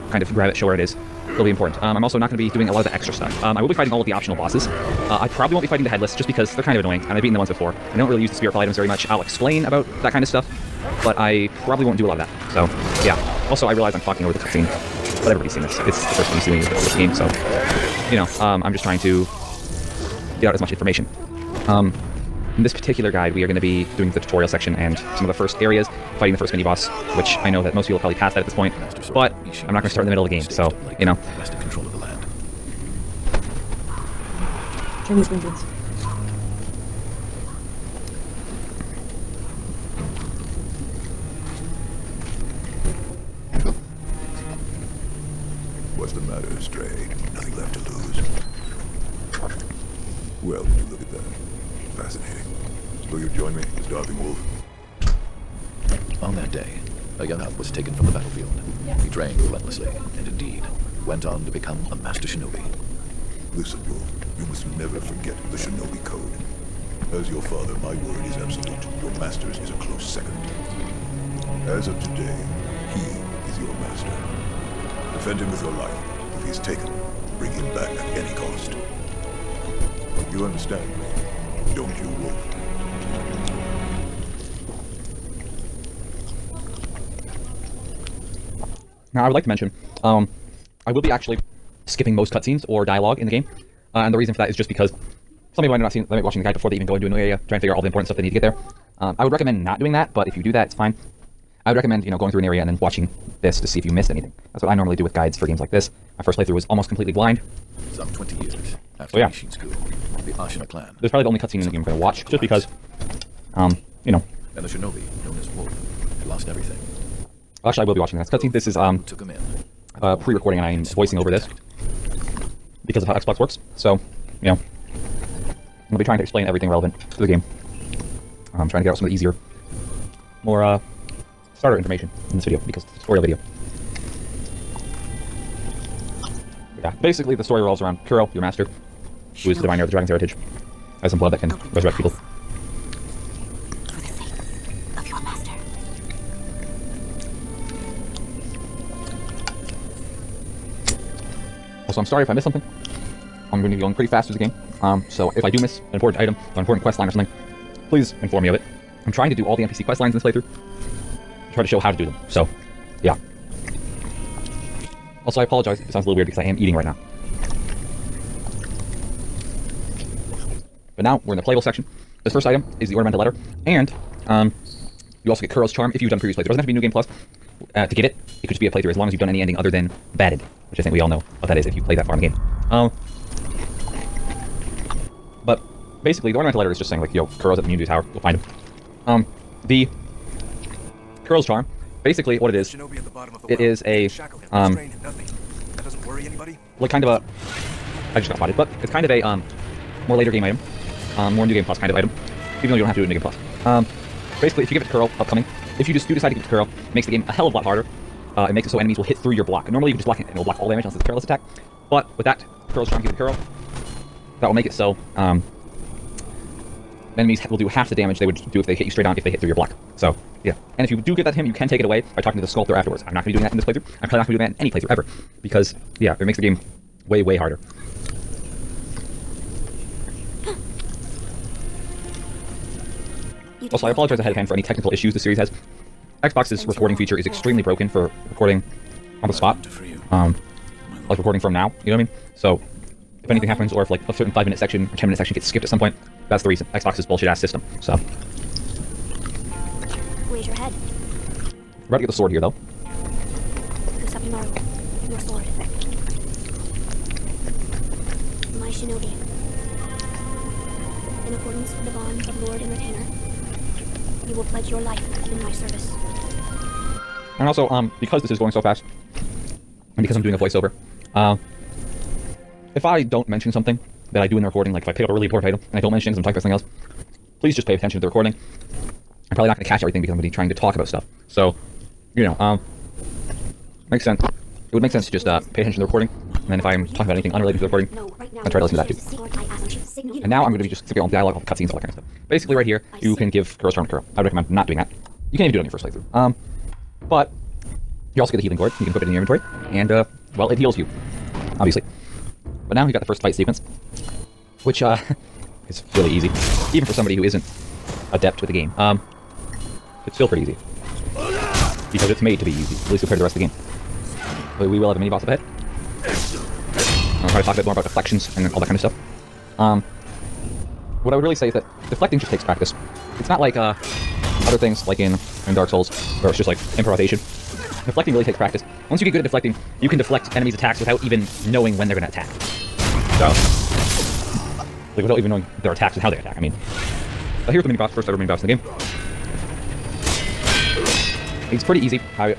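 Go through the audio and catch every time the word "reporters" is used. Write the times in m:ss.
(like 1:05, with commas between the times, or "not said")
not said.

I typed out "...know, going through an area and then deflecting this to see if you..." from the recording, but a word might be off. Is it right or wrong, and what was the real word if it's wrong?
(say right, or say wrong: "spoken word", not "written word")
wrong: "watching", not "deflecting".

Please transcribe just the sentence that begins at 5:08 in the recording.
Um, it's still pretty easy because it's made to be easy, at least compared to the rest of the game.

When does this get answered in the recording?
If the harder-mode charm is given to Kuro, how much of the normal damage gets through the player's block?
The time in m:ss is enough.
3:37.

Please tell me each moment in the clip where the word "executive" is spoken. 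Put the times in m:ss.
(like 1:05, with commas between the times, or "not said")
not said.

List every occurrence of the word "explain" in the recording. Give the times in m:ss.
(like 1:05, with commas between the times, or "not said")
0:09, 2:06.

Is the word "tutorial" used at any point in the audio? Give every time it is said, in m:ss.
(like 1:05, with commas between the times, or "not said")
0:24, 2:13.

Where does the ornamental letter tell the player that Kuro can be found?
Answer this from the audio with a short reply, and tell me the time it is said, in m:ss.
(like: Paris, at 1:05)
Moon-view Tower, at 3:07.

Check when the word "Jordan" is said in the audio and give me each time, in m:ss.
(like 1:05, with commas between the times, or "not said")
not said.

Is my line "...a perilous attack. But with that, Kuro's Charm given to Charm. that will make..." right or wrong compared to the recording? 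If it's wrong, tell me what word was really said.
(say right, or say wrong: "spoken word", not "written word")
wrong: "Kuro", not "Charm".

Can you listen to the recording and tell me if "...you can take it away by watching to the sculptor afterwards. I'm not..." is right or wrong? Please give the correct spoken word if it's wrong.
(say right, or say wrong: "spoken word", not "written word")
wrong: "talking", not "watching".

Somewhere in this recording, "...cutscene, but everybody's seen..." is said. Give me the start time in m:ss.
0:14.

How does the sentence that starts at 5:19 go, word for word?
Um, what I would really say is that deflecting just takes practice.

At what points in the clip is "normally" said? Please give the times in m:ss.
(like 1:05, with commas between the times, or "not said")
1:44, 3:29.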